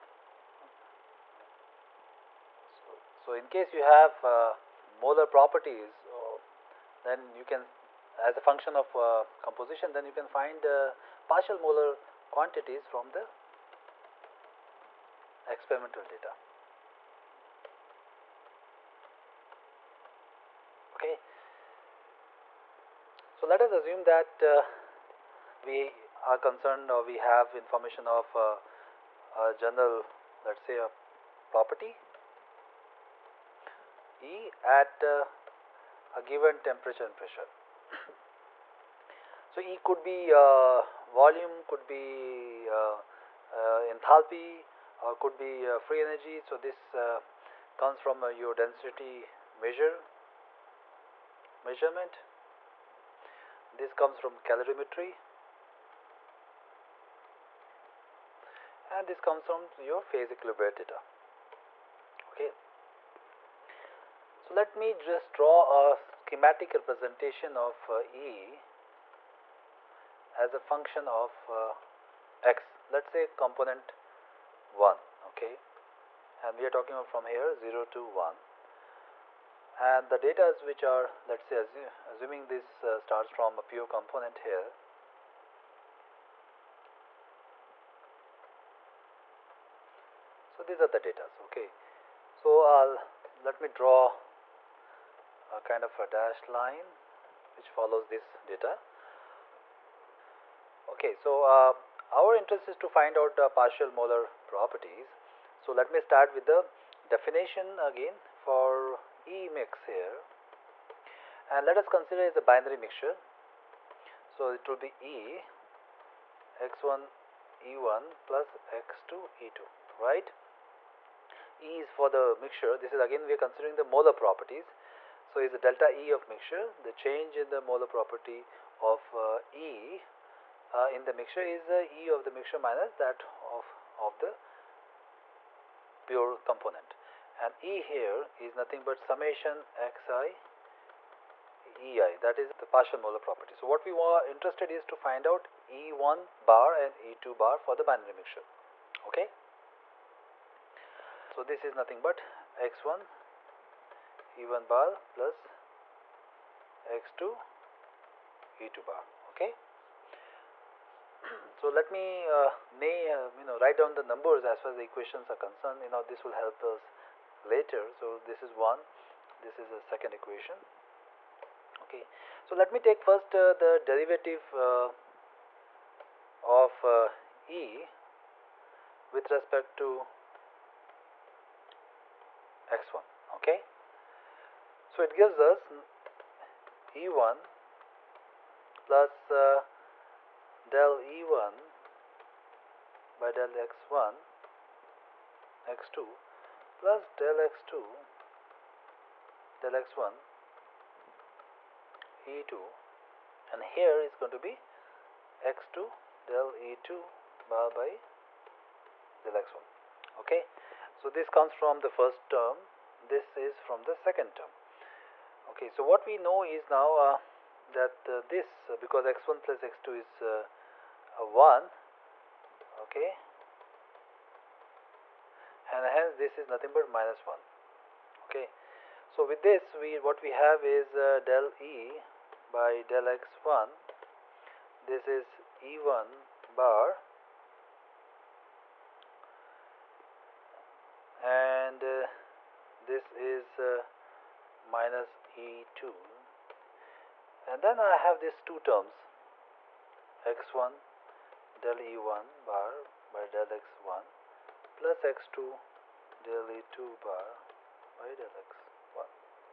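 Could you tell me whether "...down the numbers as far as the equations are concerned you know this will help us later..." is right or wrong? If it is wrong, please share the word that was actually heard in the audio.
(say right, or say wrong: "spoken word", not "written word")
right.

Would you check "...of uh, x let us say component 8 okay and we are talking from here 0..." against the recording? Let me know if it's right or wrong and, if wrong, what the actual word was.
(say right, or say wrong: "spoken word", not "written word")
wrong: "1", not "8".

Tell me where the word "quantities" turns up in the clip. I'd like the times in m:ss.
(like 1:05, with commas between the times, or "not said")
0:12.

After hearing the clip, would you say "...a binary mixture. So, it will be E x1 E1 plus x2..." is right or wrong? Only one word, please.
right.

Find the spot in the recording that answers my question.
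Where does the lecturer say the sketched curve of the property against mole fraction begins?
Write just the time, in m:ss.
1:23.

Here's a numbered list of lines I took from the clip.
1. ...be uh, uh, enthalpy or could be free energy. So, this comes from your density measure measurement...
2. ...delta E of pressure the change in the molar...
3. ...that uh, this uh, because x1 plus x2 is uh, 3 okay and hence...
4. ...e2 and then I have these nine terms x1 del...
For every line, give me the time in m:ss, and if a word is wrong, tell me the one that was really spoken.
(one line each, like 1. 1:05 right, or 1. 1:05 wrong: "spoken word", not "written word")
1. 0:41 right
2. 2:05 wrong: "mixture", not "pressure"
3. 3:37 wrong: "1", not "3"
4. 4:05 wrong: "two", not "nine".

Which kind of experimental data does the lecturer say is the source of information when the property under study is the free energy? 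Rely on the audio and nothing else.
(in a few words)
Phase equilibrium data.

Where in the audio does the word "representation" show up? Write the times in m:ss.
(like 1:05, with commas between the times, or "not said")
1:06.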